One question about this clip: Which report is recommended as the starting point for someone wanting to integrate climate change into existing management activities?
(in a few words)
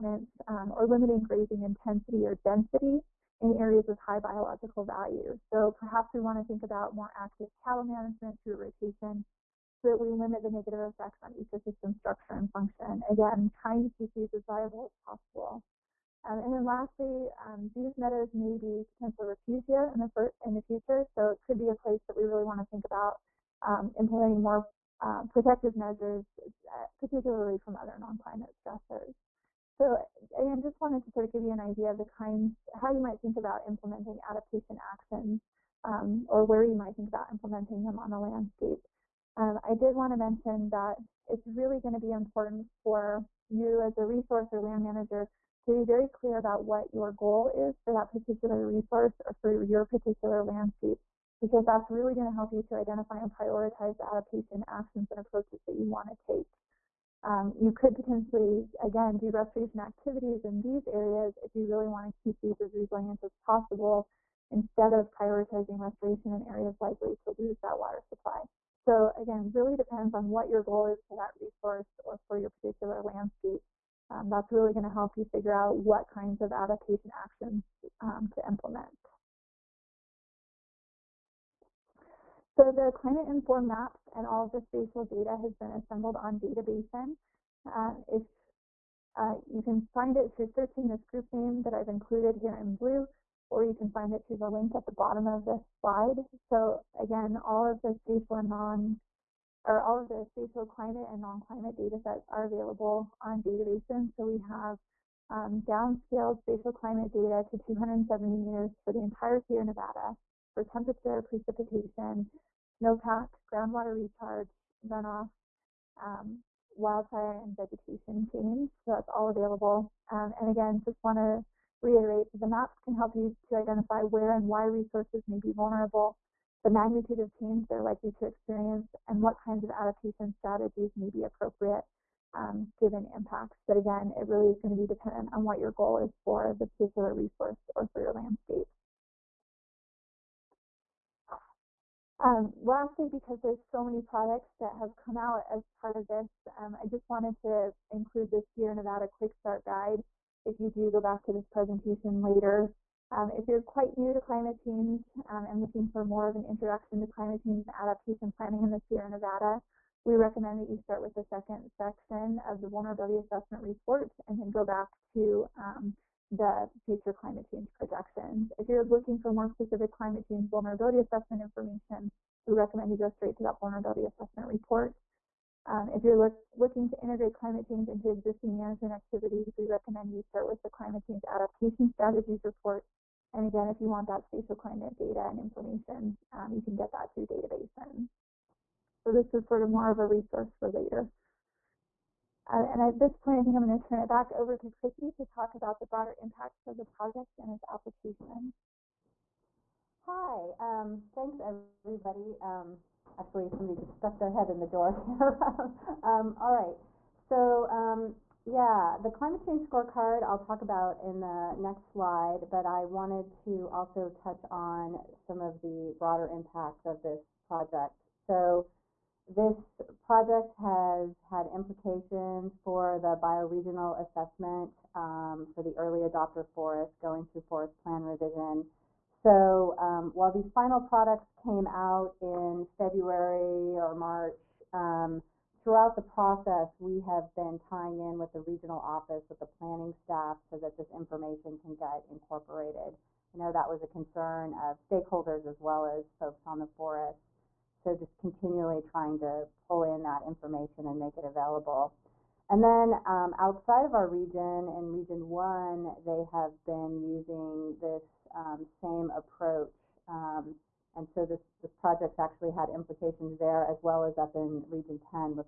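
Climate Change Adaptation Strategies report.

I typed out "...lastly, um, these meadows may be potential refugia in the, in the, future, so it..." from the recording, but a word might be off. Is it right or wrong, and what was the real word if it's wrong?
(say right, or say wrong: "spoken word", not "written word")
right.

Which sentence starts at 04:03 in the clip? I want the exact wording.
I know that was a concern of stakeholders as well as folks on the forest.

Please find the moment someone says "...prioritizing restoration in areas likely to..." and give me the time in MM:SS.
01:05.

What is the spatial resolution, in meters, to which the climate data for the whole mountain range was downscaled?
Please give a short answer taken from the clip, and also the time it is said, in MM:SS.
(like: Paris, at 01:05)
270 meters, at 01:47.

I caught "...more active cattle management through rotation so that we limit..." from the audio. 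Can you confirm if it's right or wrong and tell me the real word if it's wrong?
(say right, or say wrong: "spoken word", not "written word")
right.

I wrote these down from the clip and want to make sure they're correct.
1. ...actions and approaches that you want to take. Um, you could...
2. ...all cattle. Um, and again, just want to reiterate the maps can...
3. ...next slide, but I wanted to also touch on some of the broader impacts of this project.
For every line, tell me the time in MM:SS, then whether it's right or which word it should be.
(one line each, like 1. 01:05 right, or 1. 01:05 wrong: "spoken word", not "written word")
1. 00:54 right
2. 01:59 wrong: "available", not "cattle"
3. 03:31 right.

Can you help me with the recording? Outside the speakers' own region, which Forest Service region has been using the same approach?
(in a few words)
Region 1.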